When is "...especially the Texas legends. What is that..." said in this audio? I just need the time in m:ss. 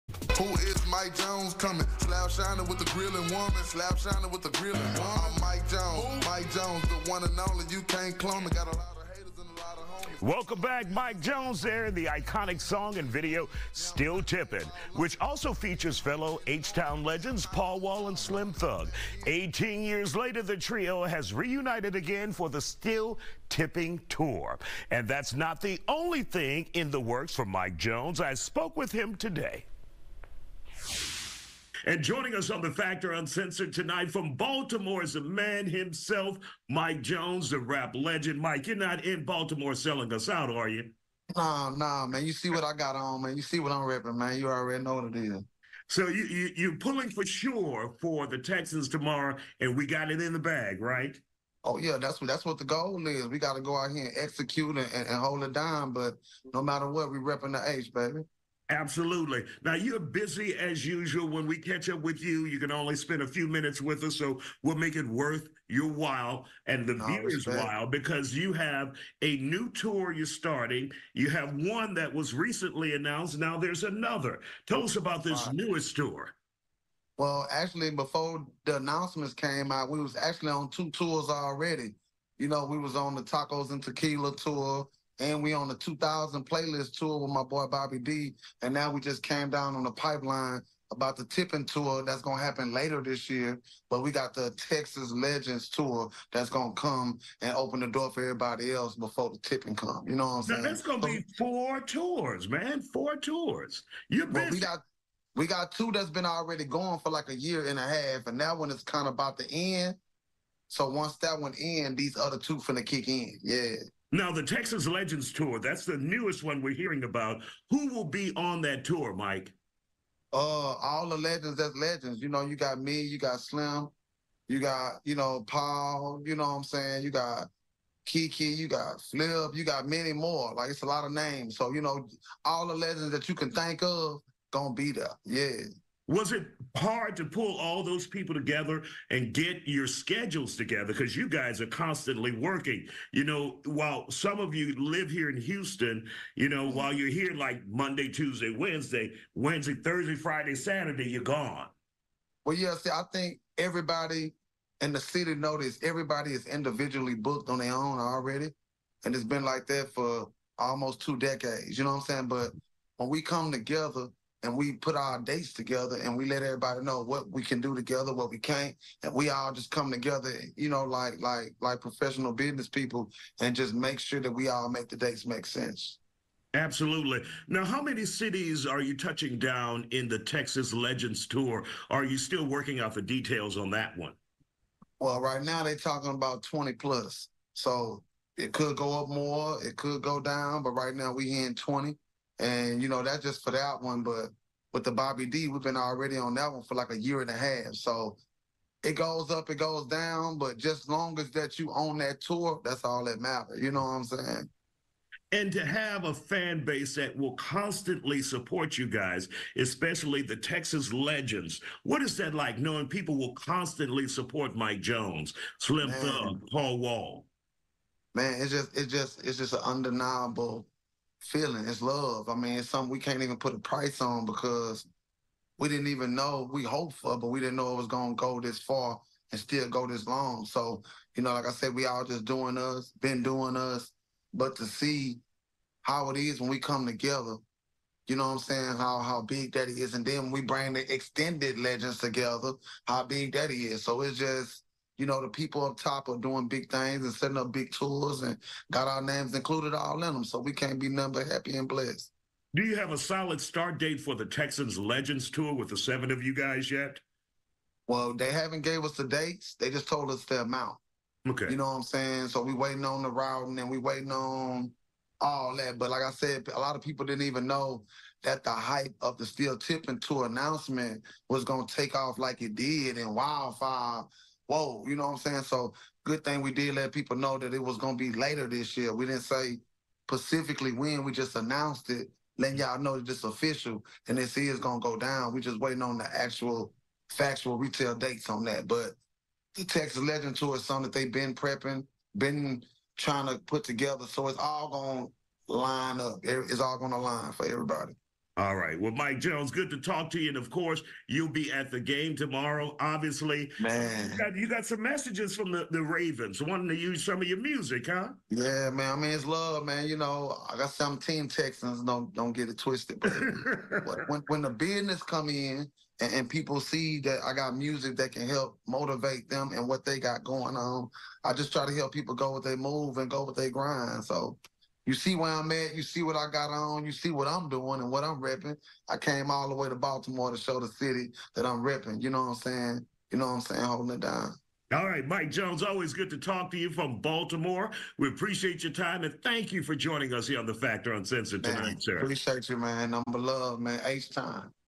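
3:29.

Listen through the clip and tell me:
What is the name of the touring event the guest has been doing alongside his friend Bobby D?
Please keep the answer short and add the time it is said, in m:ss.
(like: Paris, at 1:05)
2000 playlist tour, at 1:25.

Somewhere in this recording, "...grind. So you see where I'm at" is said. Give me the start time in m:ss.
5:23.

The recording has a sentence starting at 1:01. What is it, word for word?
When we catch up with you, you can only spend a few minutes with us.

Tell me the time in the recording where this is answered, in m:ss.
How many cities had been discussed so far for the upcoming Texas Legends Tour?
3:06.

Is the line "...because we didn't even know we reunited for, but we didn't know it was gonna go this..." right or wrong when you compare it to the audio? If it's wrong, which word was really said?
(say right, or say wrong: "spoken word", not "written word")
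wrong: "hoped", not "reunited".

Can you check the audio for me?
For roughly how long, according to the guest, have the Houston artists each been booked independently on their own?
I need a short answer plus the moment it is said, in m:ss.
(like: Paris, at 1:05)
Almost two decades, at 2:40.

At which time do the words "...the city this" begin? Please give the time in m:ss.
2:34.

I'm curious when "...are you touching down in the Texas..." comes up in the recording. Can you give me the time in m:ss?
2:58.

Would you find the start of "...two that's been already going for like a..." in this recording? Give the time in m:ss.
1:45.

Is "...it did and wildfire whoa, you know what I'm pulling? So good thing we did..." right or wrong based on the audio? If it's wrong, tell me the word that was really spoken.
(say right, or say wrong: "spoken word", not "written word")
wrong: "saying", not "pulling".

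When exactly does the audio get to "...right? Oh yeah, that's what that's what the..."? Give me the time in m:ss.
0:50.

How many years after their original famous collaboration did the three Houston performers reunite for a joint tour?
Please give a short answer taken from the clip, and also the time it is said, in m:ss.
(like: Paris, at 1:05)
18, at 0:19.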